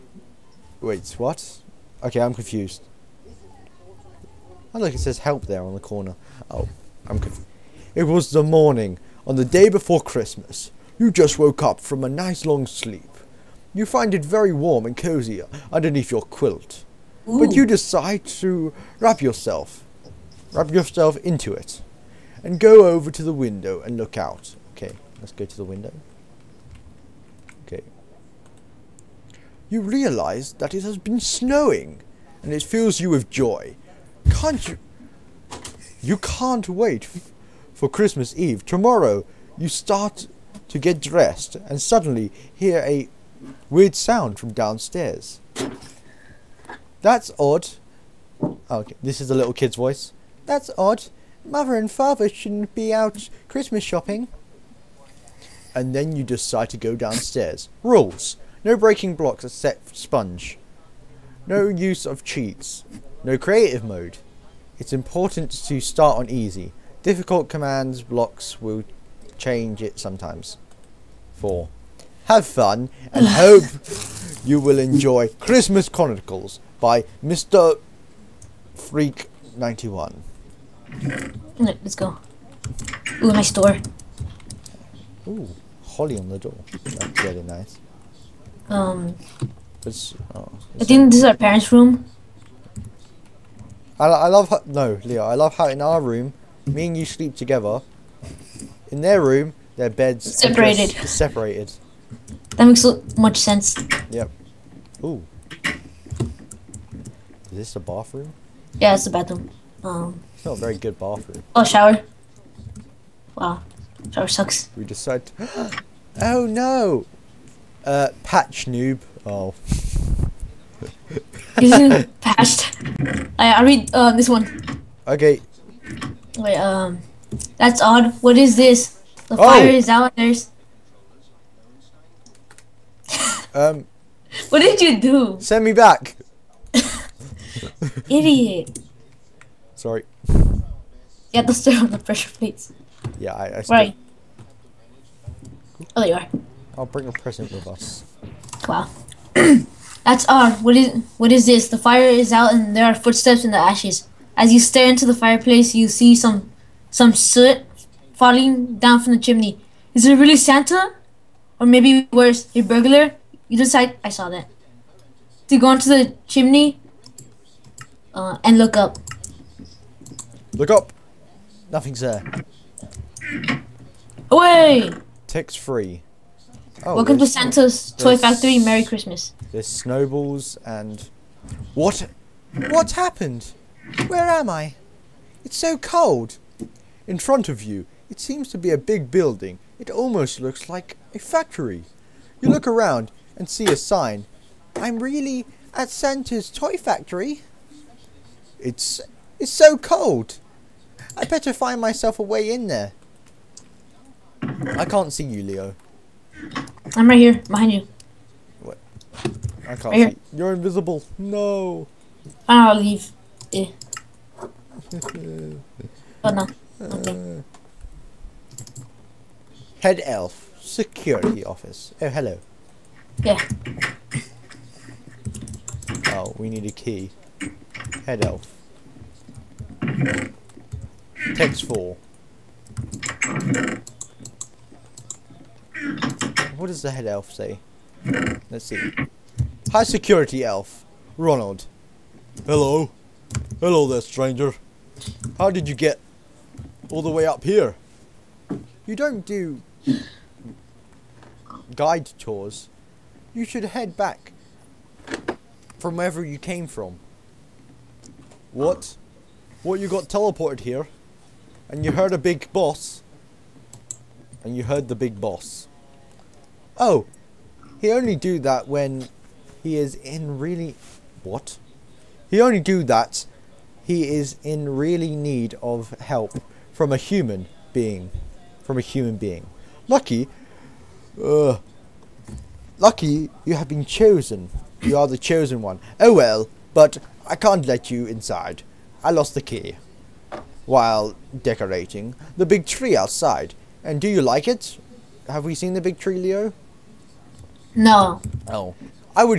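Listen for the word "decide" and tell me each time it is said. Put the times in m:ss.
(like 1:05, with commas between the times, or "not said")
0:17, 0:56, 1:54, 2:43.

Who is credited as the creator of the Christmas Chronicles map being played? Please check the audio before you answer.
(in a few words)
Mr. Freak91.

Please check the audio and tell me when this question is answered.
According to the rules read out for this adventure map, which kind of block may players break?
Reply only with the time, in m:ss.
0:59.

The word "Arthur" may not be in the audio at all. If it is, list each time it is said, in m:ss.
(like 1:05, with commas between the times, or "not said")
not said.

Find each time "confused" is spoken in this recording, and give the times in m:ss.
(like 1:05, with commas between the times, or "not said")
0:02, 0:07.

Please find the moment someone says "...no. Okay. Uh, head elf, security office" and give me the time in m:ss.
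3:36.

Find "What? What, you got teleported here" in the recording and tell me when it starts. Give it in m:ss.
4:18.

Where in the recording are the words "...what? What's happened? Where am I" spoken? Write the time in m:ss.
3:01.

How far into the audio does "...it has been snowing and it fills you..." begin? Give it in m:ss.
0:30.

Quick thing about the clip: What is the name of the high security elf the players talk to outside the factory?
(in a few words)
Ronald.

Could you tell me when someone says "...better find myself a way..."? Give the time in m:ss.
3:21.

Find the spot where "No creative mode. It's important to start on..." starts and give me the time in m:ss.
1:03.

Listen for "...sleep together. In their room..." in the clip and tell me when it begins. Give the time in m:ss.
1:37.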